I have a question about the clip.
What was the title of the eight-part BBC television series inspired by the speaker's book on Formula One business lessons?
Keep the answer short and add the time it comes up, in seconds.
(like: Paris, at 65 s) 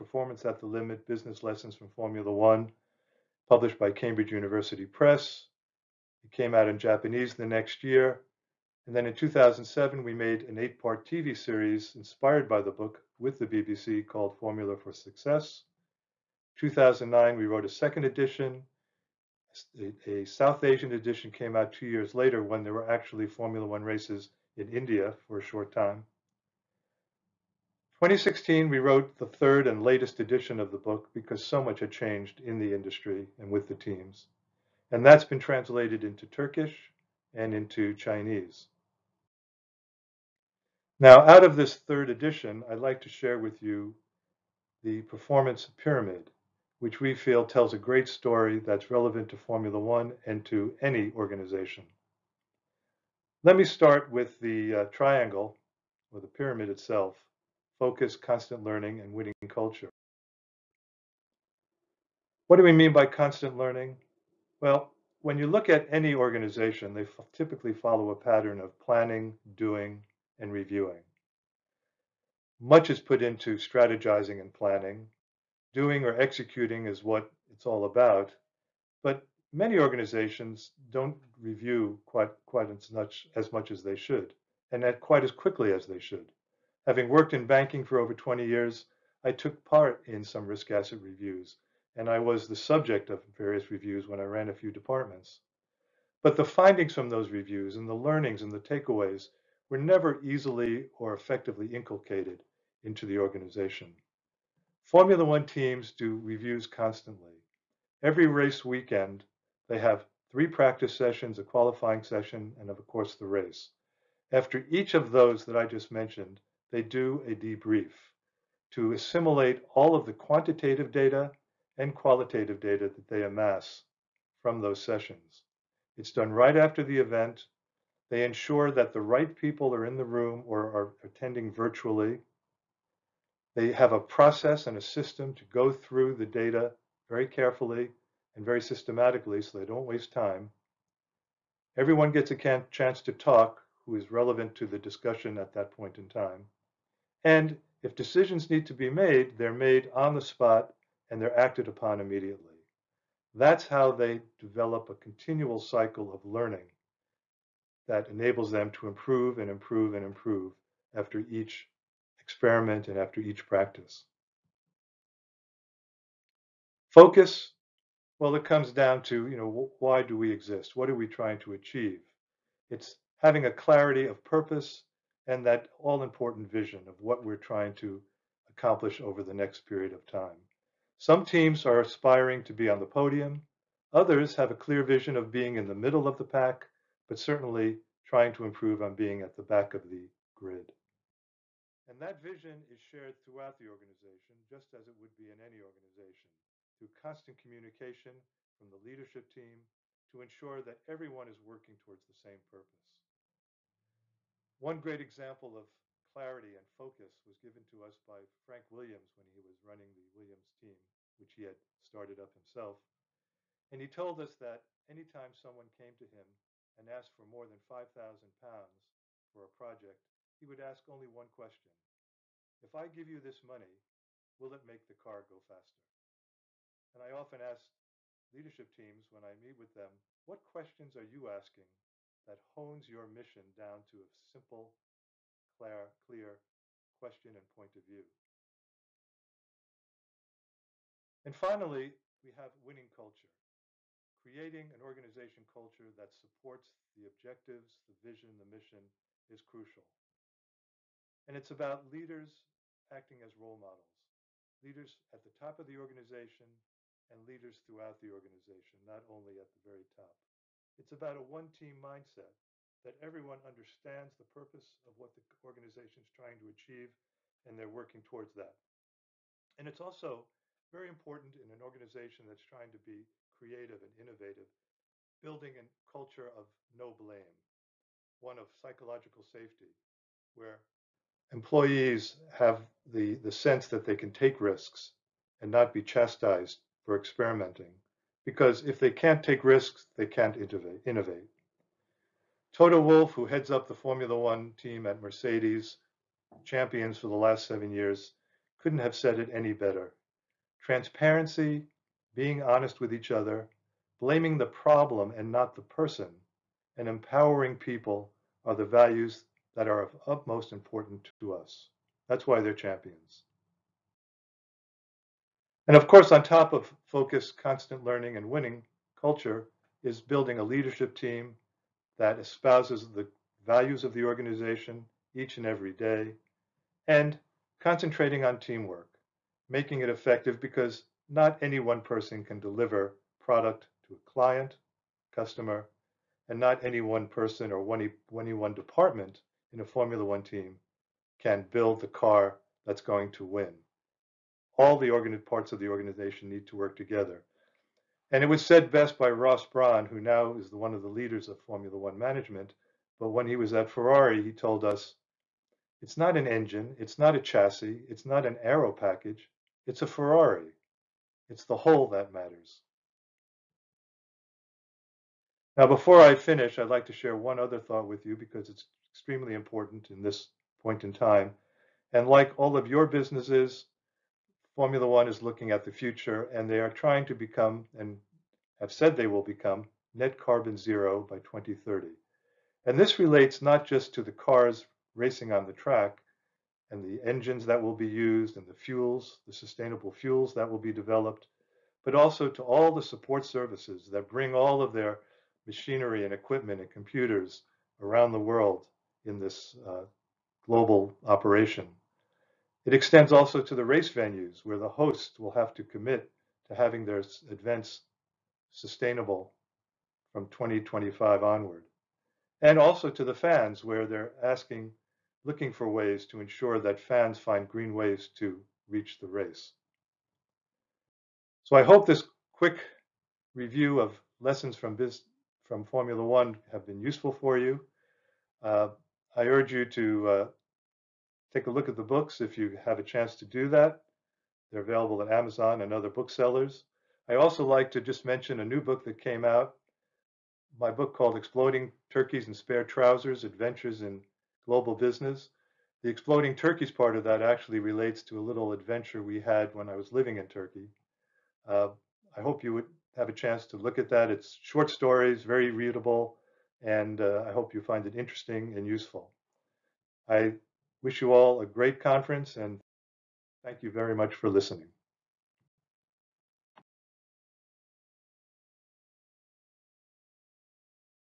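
Formula for Success, at 14 s.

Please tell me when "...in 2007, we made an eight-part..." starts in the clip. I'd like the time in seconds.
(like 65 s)
9 s.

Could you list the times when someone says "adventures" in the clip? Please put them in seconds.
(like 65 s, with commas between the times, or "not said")
443 s, 448 s.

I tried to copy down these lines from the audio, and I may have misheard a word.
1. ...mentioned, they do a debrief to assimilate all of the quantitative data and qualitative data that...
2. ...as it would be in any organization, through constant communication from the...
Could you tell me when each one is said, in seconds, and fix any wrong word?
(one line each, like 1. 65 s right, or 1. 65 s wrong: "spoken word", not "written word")
1. 115 s right
2. 194 s right.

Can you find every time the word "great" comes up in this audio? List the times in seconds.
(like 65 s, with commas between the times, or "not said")
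47 s, 204 s, 461 s.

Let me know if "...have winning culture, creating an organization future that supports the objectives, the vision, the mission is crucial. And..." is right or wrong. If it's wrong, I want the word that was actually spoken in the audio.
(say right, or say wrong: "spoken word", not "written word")
wrong: "culture", not "future".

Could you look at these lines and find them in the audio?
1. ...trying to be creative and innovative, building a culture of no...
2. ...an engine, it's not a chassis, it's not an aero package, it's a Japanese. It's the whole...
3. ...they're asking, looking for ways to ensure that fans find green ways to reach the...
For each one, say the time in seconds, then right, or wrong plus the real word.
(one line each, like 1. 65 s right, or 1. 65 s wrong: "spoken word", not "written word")
1. 272 s right
2. 356 s wrong: "Ferrari", not "Japanese"
3. 413 s right.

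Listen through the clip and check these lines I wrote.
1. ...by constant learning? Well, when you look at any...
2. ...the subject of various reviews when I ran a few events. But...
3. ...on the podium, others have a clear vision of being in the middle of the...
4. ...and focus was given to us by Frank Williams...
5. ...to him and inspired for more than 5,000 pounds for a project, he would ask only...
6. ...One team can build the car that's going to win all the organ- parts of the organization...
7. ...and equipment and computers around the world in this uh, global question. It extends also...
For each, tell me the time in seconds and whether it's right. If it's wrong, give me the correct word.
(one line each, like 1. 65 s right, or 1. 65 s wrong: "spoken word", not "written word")
1. 62 s right
2. 92 s wrong: "departments", not "events"
3. 182 s right
4. 206 s right
5. 215 s wrong: "asked", not "inspired"
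6. 340 s right
7. 396 s wrong: "operation", not "question".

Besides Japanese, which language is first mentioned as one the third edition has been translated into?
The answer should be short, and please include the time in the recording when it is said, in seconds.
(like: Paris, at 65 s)
Turkish, at 36 s.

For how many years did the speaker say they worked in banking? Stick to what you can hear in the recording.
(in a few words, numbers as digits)
20.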